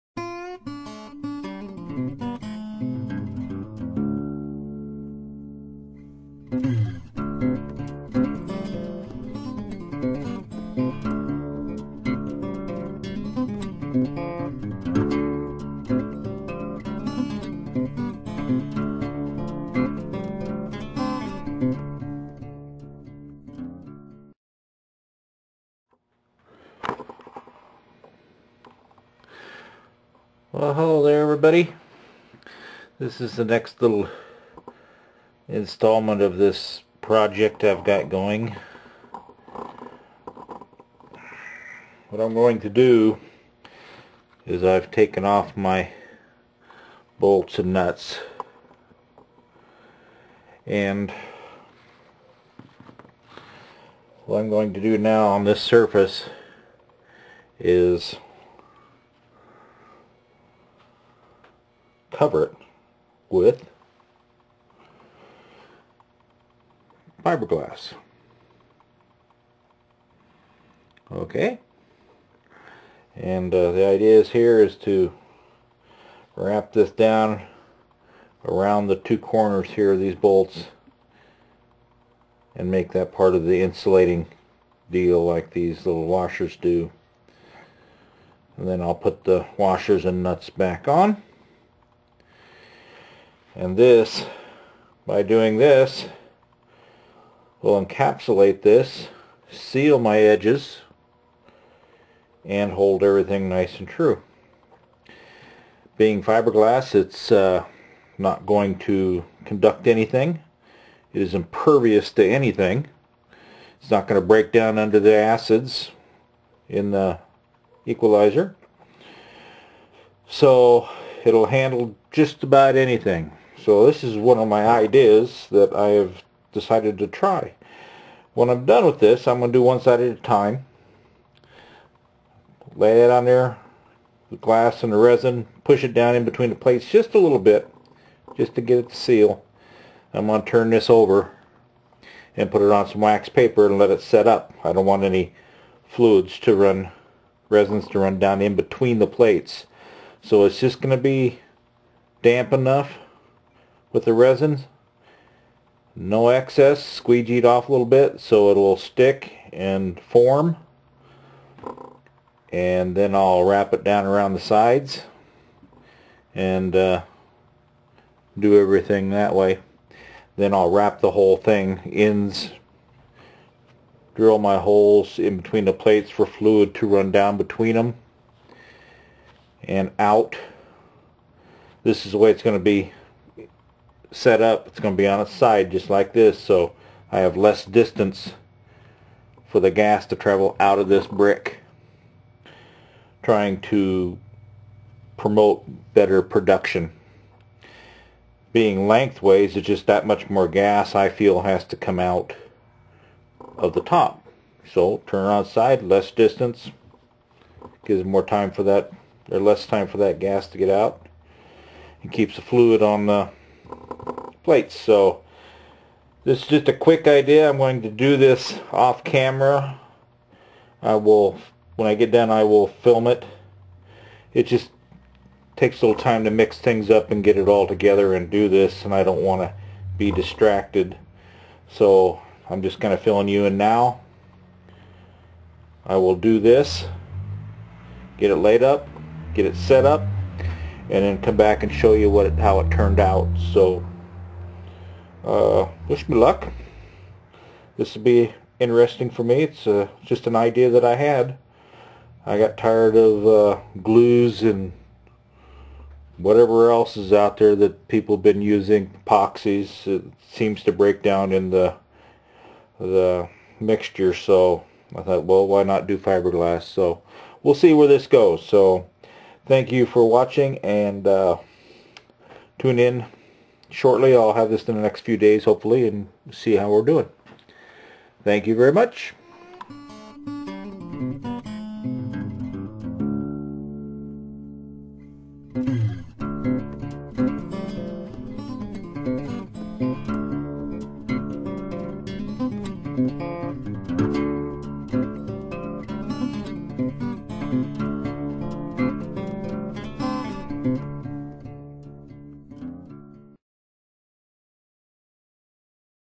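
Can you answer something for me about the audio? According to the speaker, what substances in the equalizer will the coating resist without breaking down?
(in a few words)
Acids.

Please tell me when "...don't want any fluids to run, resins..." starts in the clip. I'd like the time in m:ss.
2:24.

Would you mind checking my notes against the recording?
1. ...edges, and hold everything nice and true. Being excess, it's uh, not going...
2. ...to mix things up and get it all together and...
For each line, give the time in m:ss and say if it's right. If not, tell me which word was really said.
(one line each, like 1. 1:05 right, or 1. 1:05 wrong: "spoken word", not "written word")
1. 1:40 wrong: "fiberglass", not "excess"
2. 3:46 right.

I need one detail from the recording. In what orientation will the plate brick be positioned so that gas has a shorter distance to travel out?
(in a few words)
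On its side.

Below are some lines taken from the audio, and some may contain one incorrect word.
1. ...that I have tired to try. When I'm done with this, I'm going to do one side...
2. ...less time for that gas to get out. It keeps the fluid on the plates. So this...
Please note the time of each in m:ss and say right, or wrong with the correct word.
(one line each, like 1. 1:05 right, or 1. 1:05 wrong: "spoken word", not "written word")
1. 2:05 wrong: "decided", not "tired"
2. 3:29 right.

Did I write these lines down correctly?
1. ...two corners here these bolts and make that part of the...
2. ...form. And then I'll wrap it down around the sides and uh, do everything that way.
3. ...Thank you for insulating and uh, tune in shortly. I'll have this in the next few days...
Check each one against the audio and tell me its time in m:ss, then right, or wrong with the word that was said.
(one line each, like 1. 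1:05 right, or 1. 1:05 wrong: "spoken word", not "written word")
1. 1:18 right
2. 2:39 right
3. 4:29 wrong: "watching", not "insulating".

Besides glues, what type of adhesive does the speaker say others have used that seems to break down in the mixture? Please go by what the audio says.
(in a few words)
Epoxies.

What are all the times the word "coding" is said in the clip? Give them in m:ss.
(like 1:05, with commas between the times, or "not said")
not said.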